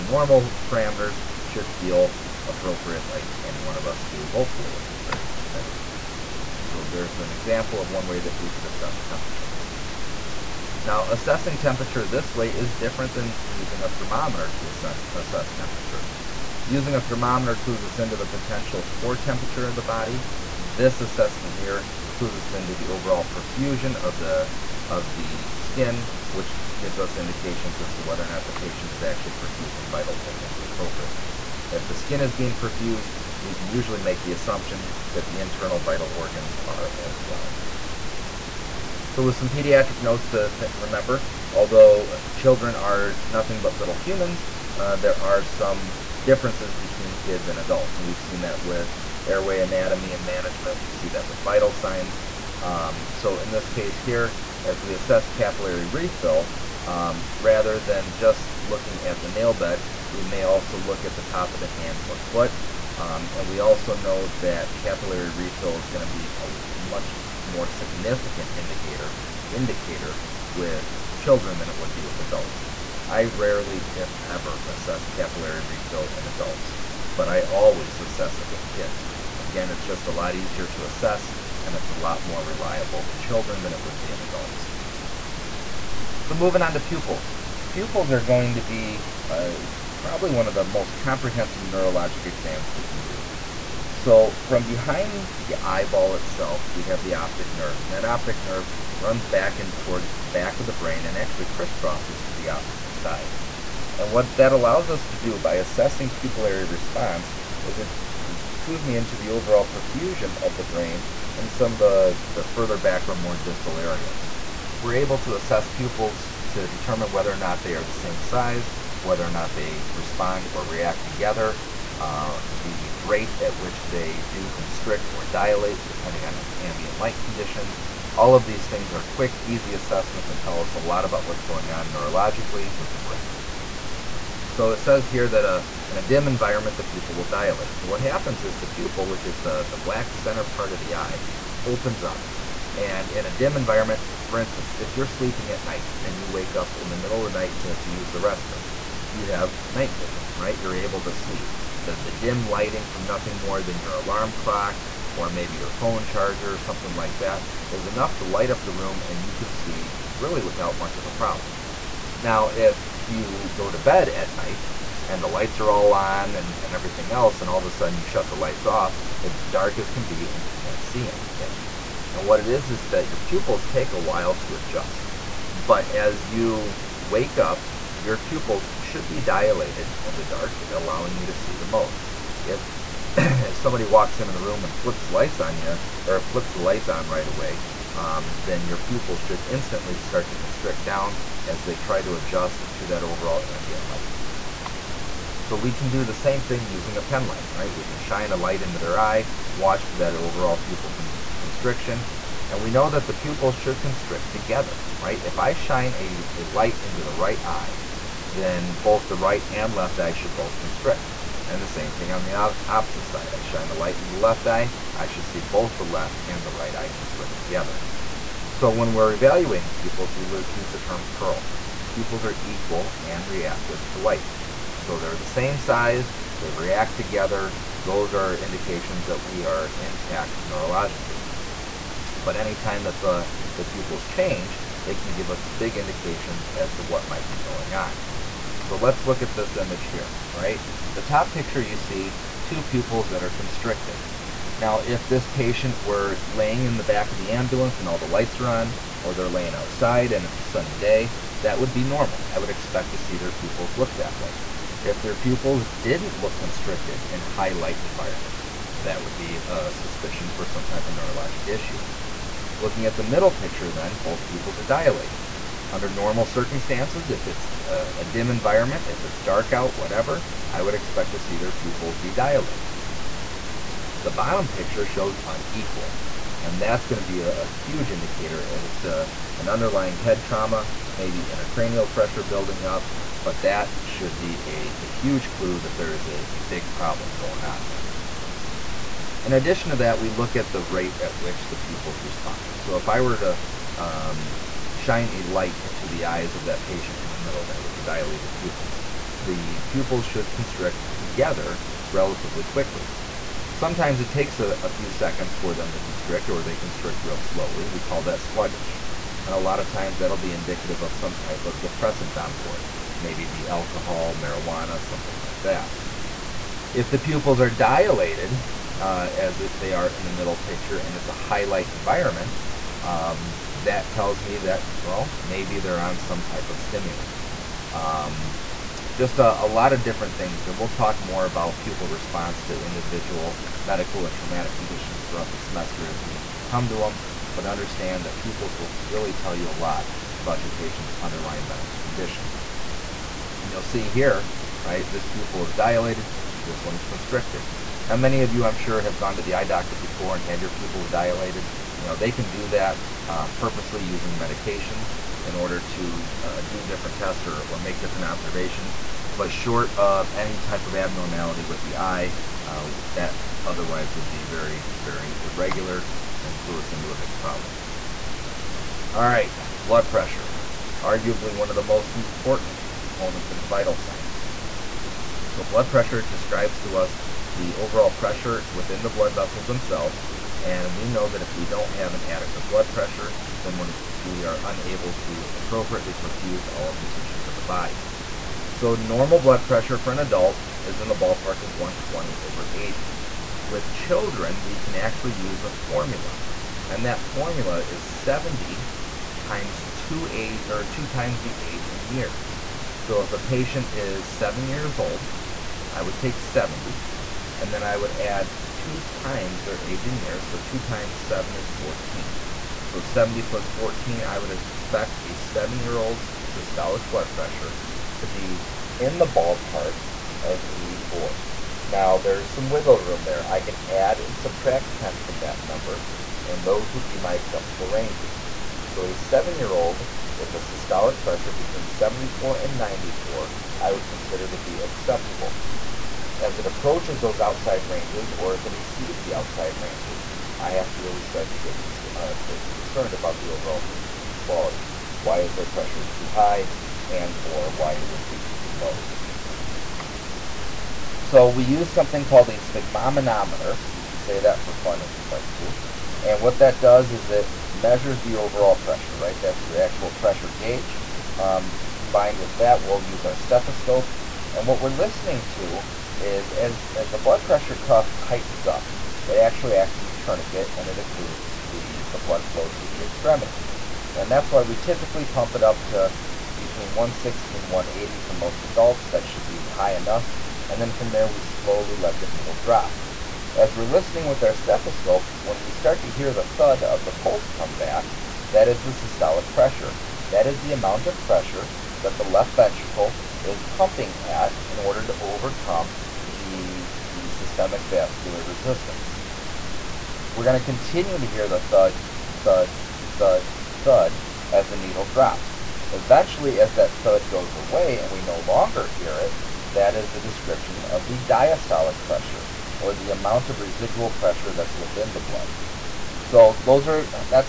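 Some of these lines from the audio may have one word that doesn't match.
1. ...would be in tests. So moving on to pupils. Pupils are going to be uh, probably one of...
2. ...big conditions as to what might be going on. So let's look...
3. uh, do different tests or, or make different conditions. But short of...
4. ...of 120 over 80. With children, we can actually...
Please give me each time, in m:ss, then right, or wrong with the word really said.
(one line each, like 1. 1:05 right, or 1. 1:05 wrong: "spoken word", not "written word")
1. 1:23 wrong: "adults", not "tests"
2. 3:55 wrong: "indications", not "conditions"
3. 5:56 wrong: "observations", not "conditions"
4. 6:31 right.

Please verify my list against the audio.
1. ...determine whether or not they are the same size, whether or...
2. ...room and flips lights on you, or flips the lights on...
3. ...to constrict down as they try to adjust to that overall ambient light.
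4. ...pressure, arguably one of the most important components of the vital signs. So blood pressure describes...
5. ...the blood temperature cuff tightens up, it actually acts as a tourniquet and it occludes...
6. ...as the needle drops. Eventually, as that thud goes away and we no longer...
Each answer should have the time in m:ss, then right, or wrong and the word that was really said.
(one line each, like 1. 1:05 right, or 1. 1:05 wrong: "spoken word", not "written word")
1. 1:56 right
2. 3:04 right
3. 3:10 right
4. 6:09 right
5. 7:46 wrong: "pressure", not "temperature"
6. 8:24 right.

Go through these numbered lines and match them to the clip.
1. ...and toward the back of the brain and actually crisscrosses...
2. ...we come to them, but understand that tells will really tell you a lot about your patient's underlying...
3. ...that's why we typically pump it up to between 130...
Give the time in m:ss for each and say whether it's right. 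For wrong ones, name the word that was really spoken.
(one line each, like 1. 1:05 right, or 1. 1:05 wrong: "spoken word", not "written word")
1. 1:39 right
2. 5:36 wrong: "pupils", not "tells"
3. 7:54 wrong: "160", not "130".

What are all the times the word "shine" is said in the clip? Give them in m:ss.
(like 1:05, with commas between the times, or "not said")
3:17, 3:25, 3:33, 4:54.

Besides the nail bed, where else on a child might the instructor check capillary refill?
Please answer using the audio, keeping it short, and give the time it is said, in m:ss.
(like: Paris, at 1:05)
top of the hand or foot, at 1:01.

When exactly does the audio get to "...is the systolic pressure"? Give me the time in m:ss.
8:08.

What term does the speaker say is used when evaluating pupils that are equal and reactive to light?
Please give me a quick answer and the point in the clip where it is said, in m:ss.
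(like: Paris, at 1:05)
PEARL, at 3:41.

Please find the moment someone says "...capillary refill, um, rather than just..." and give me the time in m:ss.
0:55.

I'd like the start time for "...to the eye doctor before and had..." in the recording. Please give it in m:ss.
5:49.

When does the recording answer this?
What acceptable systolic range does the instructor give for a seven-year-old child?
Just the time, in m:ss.
7:11.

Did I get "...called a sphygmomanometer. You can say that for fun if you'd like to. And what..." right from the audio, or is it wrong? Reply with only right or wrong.
right.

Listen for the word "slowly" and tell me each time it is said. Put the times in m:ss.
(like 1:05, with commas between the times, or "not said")
5:07, 8:01.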